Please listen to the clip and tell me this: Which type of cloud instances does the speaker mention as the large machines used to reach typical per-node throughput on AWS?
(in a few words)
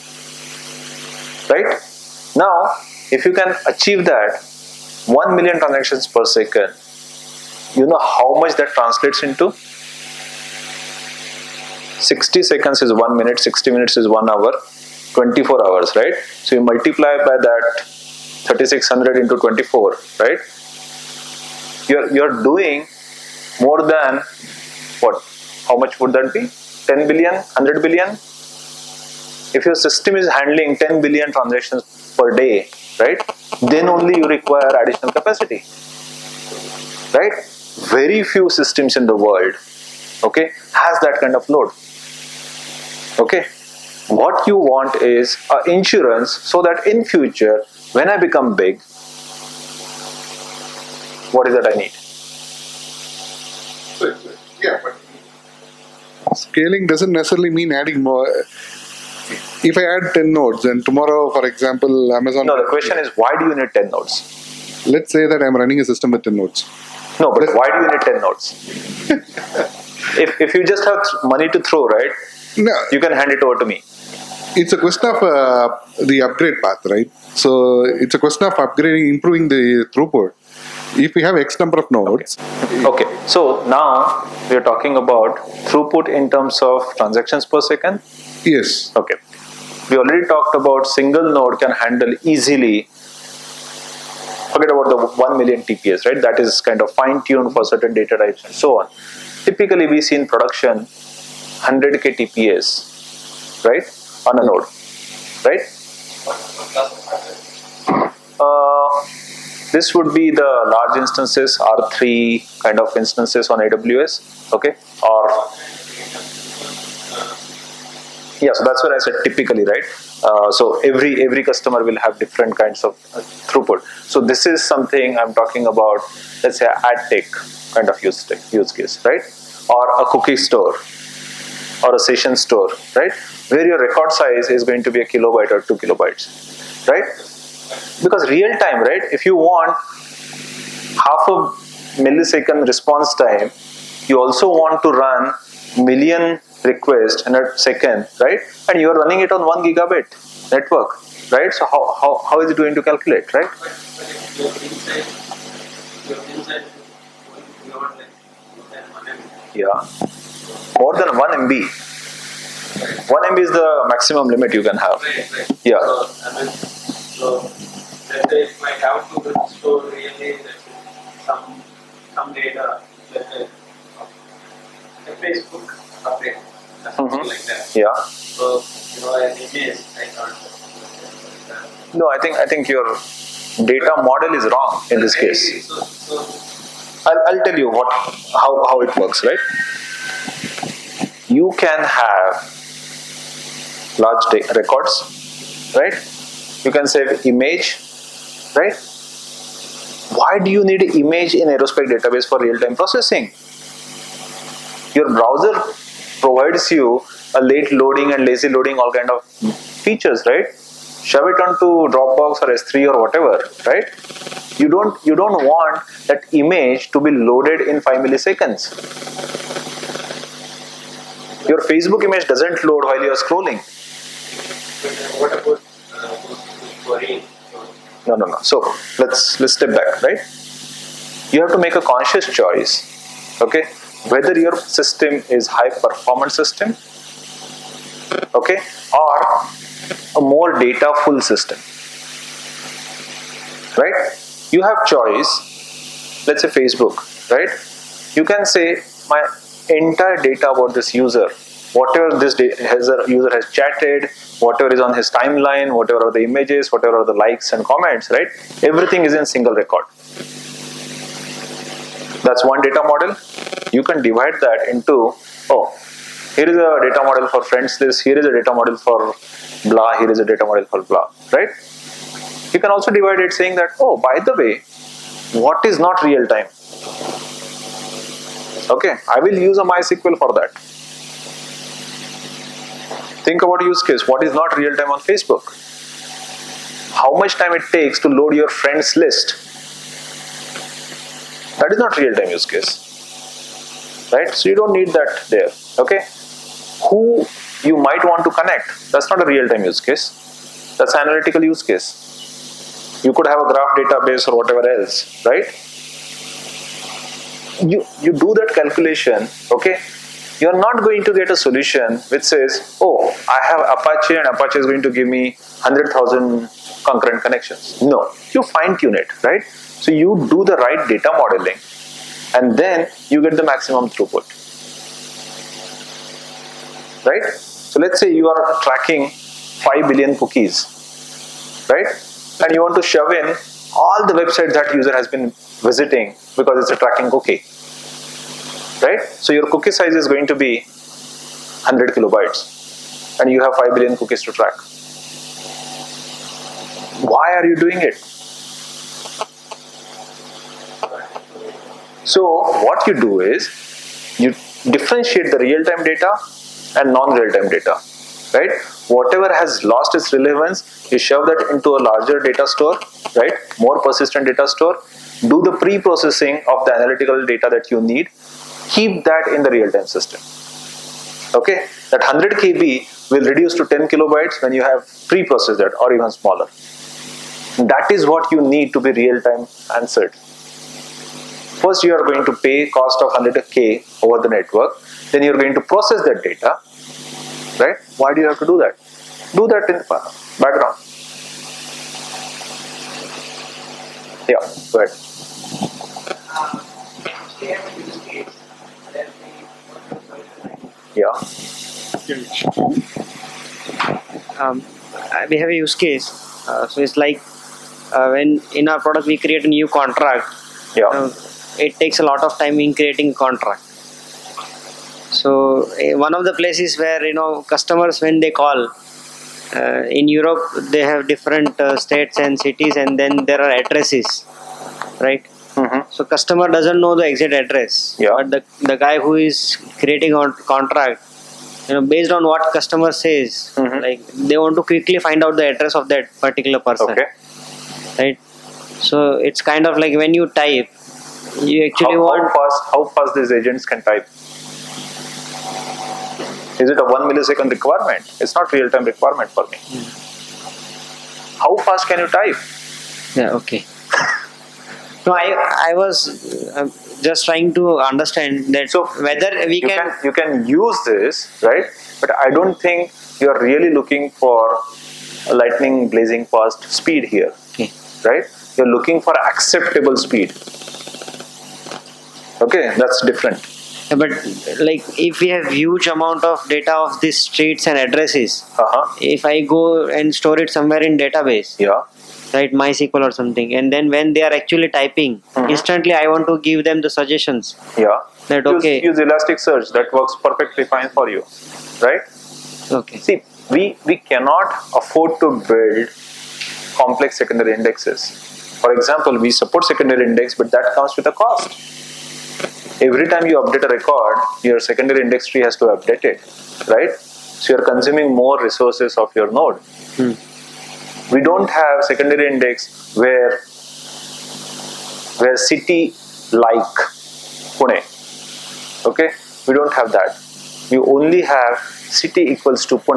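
R3.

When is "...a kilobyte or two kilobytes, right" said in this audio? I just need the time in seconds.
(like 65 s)
135 s.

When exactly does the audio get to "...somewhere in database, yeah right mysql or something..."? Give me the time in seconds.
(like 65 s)
480 s.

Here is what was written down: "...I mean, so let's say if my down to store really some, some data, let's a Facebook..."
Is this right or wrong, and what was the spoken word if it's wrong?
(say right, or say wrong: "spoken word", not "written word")
right.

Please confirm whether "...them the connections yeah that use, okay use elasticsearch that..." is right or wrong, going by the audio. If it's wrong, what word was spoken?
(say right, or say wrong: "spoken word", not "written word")
wrong: "suggestions", not "connections".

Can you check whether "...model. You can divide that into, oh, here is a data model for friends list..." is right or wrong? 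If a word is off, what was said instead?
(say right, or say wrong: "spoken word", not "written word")
right.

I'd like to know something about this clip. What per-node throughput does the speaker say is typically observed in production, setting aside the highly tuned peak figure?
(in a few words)
100k TPS.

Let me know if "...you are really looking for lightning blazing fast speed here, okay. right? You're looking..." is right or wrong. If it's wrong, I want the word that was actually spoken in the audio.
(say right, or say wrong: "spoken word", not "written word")
right.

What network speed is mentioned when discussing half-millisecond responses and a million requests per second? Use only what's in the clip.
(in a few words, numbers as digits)
1 gigabit.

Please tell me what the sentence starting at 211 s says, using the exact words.
Shove it onto Dropbox or S3 or whatever, right?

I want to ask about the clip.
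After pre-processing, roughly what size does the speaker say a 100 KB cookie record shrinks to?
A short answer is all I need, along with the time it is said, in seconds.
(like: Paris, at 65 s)
10 kilobytes, at 373 s.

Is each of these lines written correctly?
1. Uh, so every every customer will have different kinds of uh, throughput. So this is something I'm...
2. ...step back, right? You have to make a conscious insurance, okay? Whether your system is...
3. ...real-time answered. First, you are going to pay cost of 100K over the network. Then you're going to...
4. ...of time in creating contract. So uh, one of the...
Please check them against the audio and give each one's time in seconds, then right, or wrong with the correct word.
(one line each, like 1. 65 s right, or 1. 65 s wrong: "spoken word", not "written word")
1. 120 s right
2. 229 s wrong: "choice", not "insurance"
3. 378 s right
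4. 412 s right.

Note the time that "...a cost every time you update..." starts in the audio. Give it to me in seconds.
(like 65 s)
501 s.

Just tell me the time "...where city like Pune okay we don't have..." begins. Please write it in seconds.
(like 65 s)
515 s.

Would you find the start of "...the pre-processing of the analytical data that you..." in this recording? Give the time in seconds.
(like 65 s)
365 s.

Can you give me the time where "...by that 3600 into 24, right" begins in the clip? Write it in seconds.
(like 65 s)
17 s.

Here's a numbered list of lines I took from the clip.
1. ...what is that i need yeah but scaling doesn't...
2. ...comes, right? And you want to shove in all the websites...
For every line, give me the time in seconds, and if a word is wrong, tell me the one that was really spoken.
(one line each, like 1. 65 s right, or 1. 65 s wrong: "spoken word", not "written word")
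1. 51 s right
2. 330 s wrong: "cookies", not "comes".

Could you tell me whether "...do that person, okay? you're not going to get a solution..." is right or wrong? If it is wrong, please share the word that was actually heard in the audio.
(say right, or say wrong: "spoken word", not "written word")
wrong: "calculation", not "person".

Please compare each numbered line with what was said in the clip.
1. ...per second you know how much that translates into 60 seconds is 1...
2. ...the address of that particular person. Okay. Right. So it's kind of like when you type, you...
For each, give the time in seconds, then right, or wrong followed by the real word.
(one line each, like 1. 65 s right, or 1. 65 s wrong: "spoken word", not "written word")
1. 6 s right
2. 435 s right.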